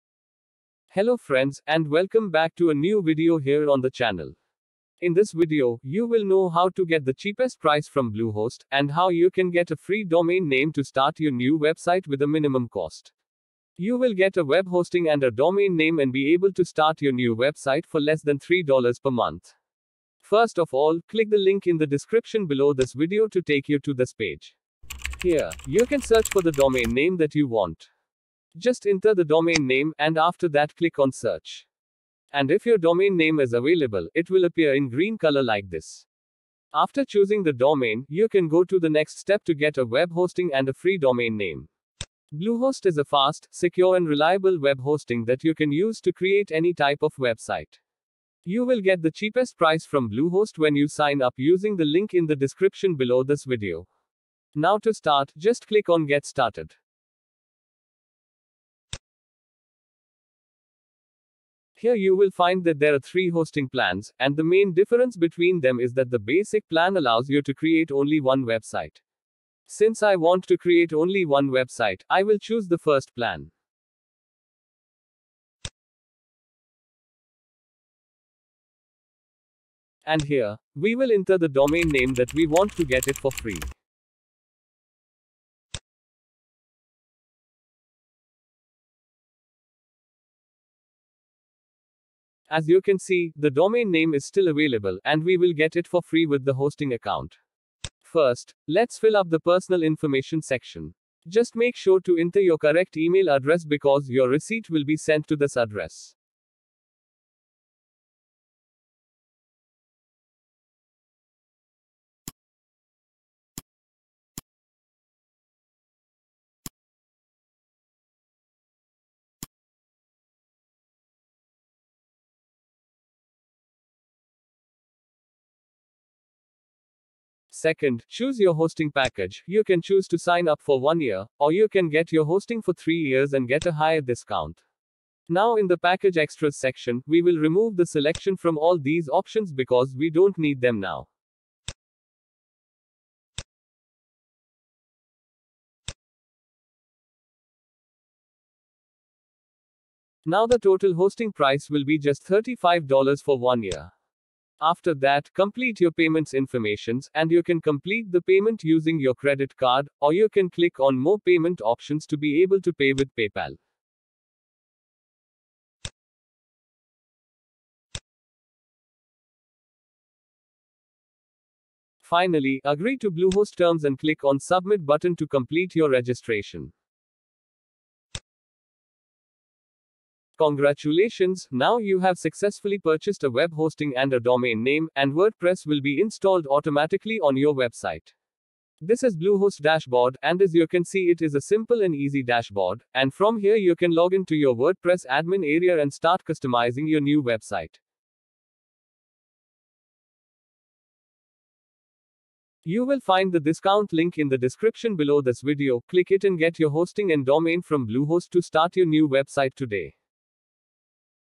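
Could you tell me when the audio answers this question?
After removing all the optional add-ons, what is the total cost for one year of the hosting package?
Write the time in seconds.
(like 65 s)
152 s.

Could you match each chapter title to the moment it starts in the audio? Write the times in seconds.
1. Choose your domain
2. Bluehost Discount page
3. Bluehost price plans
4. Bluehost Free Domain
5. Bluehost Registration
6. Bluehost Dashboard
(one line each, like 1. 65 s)
1. 20 s
2. 40 s
3. 60 s
4. 77 s
5. 90 s
6. 180 s.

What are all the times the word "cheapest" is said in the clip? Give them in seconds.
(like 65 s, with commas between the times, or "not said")
7 s, 49 s.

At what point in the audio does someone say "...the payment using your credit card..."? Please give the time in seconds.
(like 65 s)
158 s.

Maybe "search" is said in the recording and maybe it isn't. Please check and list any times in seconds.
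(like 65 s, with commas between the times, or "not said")
26 s, 31 s.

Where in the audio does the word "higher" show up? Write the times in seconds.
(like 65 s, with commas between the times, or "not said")
133 s.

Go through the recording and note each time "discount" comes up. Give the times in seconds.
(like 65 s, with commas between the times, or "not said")
133 s, 203 s.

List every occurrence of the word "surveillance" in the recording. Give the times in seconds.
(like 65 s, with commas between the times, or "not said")
not said.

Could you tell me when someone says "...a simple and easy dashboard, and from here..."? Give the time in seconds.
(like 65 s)
191 s.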